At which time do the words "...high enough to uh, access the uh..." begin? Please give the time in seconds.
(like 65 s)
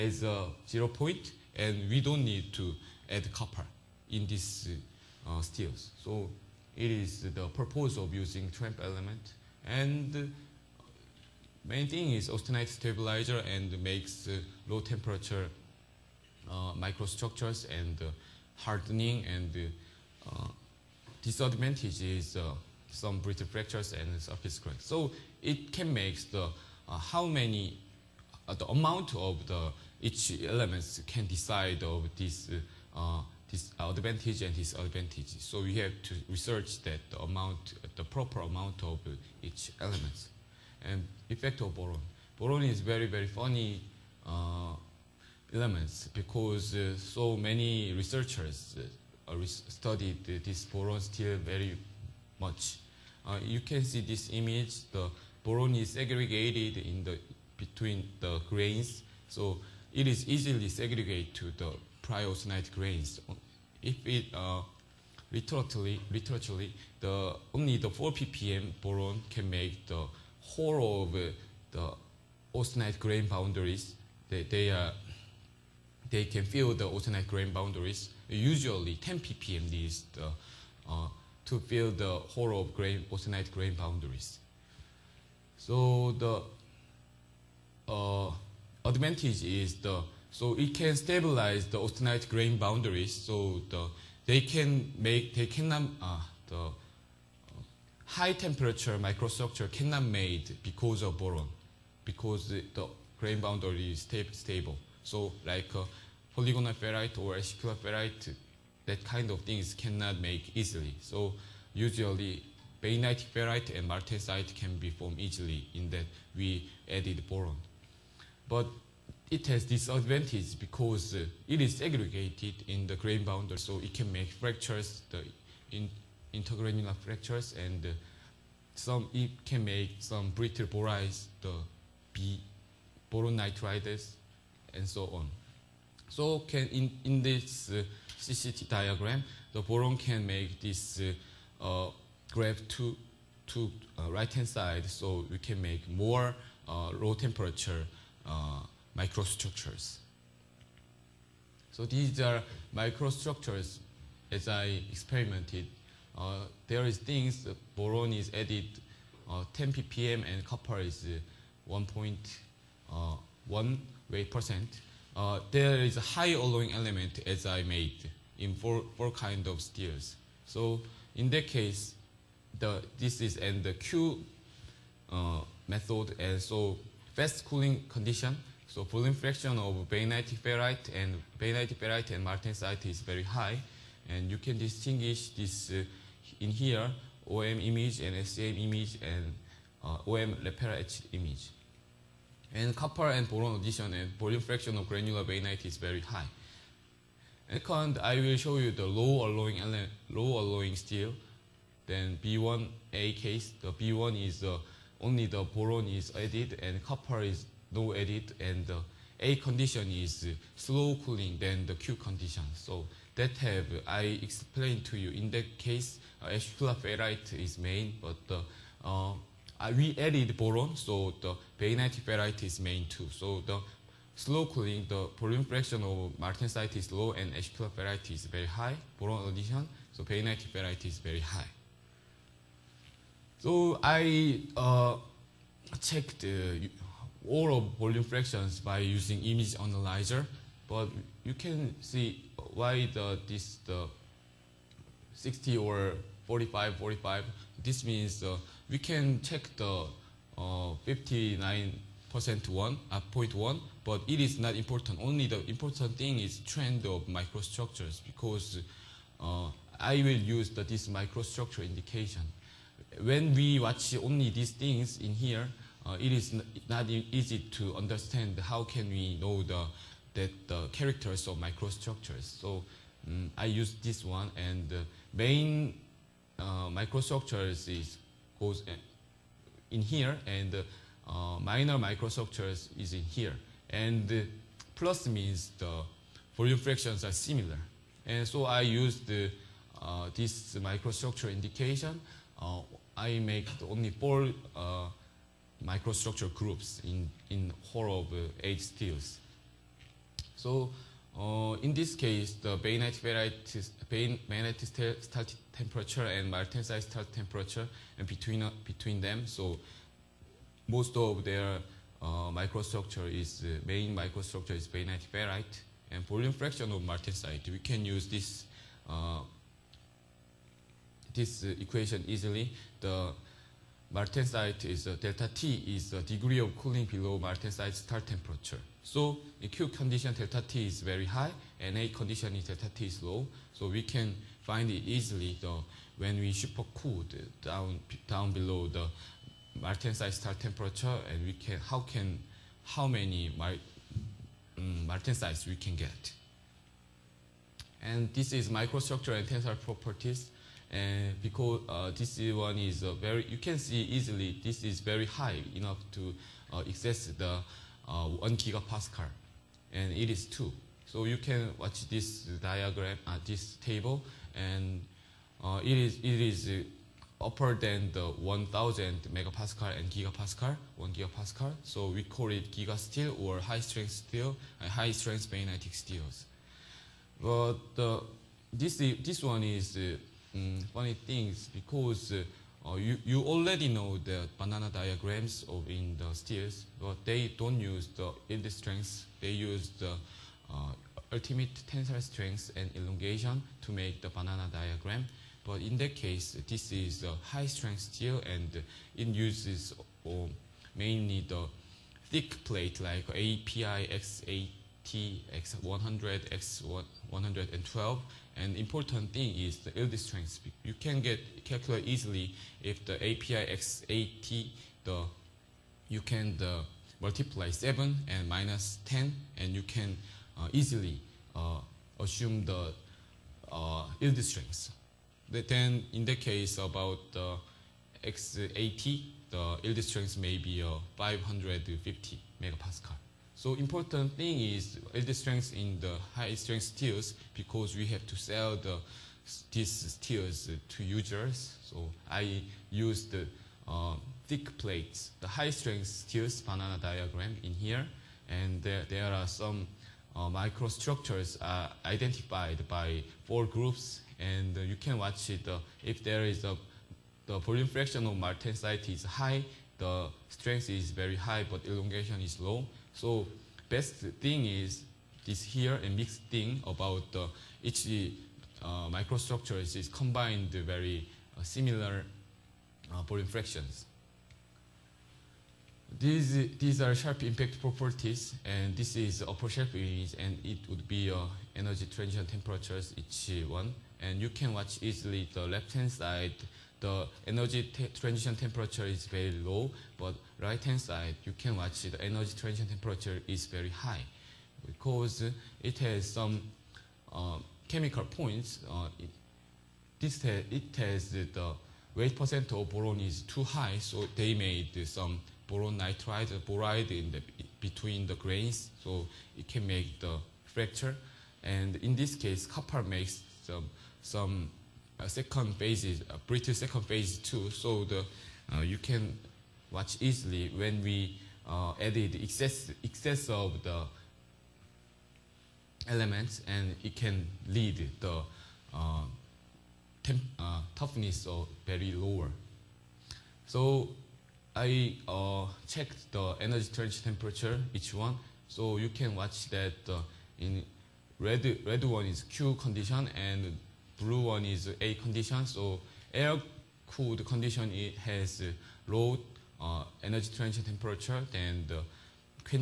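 355 s.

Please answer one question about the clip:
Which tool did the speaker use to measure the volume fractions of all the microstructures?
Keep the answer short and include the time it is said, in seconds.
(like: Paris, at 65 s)
image analyzer, at 239 s.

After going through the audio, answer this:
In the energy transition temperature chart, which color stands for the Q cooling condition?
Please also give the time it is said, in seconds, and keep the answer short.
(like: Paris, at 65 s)
red, at 541 s.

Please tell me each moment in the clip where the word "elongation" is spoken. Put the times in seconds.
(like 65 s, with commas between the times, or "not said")
392 s, 461 s.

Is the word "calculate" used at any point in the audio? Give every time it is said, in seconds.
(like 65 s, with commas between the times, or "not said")
411 s.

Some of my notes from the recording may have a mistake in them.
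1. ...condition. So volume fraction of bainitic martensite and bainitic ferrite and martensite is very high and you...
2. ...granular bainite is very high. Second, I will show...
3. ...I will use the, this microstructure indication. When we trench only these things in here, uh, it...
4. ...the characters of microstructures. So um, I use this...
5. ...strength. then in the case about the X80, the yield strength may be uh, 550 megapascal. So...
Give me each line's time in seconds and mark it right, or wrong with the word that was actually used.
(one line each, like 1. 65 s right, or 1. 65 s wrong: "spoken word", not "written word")
1. 177 s wrong: "ferrite", not "martensite"
2. 194 s right
3. 259 s wrong: "watch", not "trench"
4. 270 s right
5. 424 s right.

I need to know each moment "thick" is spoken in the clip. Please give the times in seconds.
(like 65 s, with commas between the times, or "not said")
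402 s, 444 s.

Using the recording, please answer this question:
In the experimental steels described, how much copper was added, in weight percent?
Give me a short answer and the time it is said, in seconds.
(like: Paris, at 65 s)
1.1, at 161 s.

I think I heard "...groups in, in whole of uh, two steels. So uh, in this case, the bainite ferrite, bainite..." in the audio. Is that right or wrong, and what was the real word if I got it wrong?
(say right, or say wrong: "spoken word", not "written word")
wrong: "eight", not "two".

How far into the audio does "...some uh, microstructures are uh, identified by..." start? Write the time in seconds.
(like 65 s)
449 s.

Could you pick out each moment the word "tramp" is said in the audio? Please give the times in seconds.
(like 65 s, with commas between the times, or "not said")
8 s.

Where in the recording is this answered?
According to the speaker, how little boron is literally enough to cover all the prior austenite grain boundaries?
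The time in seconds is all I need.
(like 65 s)
67 s.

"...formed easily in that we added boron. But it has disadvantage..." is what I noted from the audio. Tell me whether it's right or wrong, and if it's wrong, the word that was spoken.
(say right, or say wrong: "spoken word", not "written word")
right.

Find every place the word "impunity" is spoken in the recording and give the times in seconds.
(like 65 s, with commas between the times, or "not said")
not said.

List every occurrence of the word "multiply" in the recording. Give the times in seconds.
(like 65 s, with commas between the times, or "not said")
416 s.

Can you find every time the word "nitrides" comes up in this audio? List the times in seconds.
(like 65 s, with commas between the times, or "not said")
133 s, 505 s.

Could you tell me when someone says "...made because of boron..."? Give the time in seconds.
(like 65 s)
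100 s.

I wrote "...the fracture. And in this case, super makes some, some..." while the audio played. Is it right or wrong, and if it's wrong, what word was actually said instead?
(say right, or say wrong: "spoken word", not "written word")
wrong: "copper", not "super".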